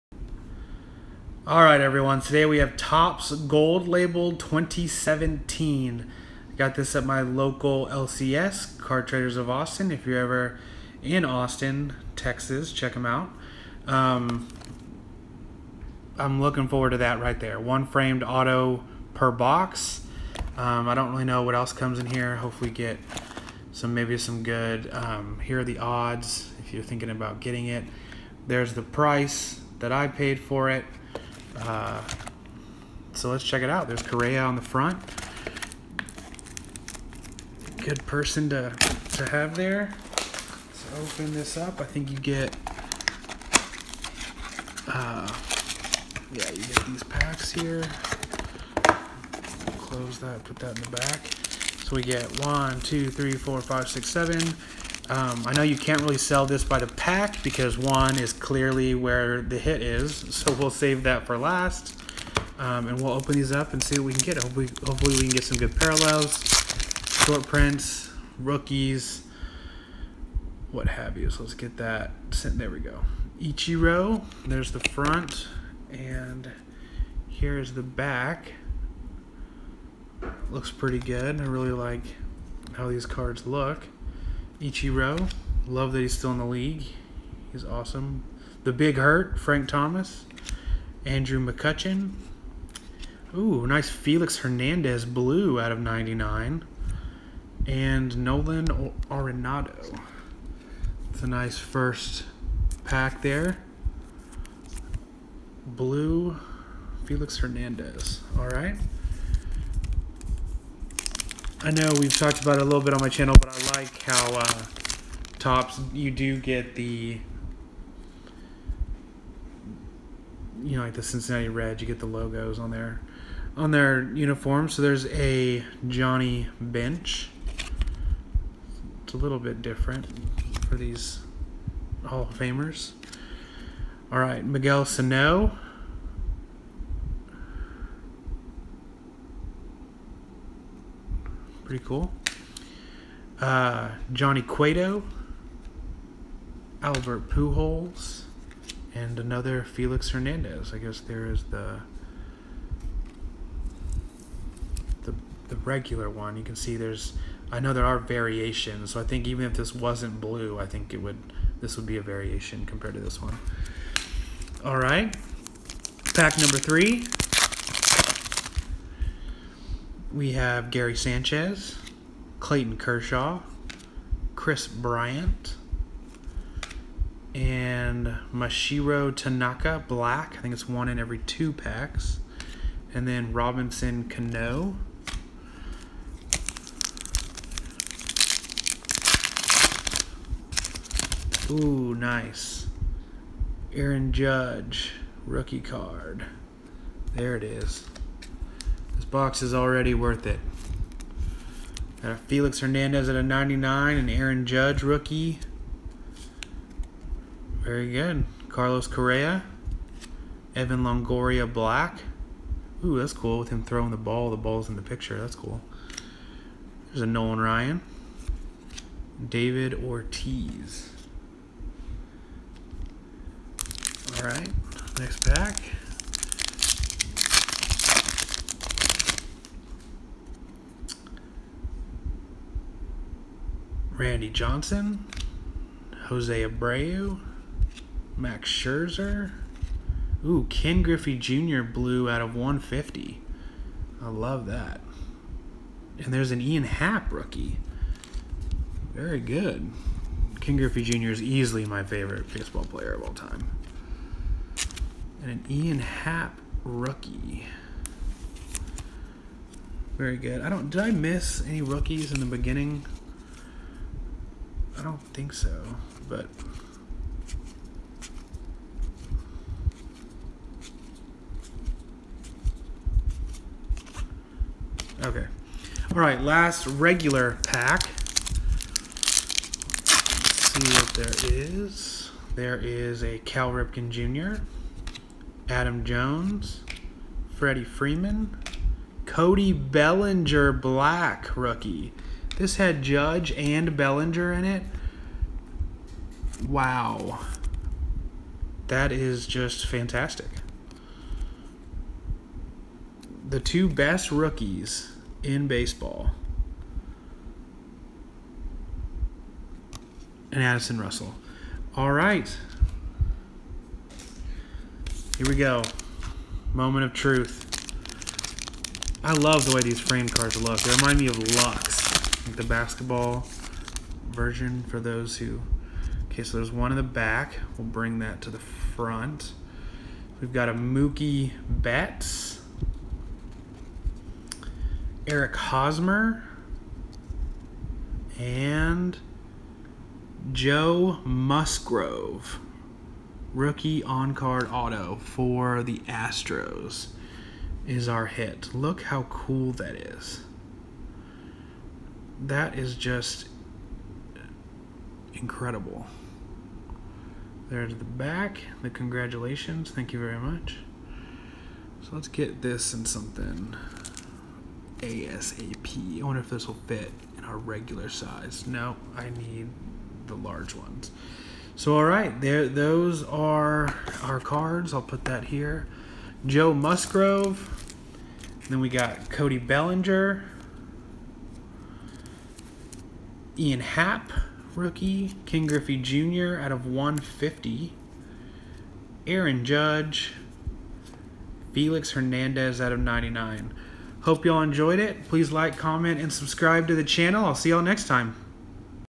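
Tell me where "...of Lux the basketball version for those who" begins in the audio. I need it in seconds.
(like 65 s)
321 s.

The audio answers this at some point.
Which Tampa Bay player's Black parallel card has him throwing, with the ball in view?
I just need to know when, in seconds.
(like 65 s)
210 s.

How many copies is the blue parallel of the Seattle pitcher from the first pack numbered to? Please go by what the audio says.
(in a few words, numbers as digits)
99.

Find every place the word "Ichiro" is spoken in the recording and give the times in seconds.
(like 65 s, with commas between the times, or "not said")
73 s, 84 s.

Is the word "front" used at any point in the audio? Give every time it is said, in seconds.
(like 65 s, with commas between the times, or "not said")
34 s, 74 s, 328 s.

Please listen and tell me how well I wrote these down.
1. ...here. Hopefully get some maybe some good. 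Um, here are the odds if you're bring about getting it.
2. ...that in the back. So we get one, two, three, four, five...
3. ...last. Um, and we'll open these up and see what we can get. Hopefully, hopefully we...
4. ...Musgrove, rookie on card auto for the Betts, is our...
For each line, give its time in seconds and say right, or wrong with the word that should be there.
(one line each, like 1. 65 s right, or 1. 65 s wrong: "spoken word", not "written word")
1. 22 s wrong: "thinking", not "bring"
2. 50 s right
3. 61 s right
4. 341 s wrong: "Astros", not "Betts".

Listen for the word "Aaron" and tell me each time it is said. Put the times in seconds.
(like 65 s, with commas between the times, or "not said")
193 s, 204 s, 389 s.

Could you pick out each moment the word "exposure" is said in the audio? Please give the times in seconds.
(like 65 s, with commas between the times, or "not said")
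not said.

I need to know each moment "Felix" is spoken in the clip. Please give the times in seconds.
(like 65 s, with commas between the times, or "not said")
93 s, 107 s, 149 s, 202 s, 391 s.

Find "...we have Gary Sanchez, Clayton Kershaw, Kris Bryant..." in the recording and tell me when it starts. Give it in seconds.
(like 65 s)
170 s.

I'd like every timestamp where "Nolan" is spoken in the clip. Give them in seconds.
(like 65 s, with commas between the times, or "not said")
98 s, 217 s.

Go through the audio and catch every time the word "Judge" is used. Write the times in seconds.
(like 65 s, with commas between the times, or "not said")
194 s, 204 s, 292 s, 389 s.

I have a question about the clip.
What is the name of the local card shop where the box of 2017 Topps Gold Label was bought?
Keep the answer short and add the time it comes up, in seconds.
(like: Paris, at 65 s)
Car Traders of Austin, at 8 s.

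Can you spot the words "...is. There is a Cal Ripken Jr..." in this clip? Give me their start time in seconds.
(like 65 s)
281 s.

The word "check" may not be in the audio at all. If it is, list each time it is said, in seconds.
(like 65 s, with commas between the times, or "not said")
12 s, 33 s.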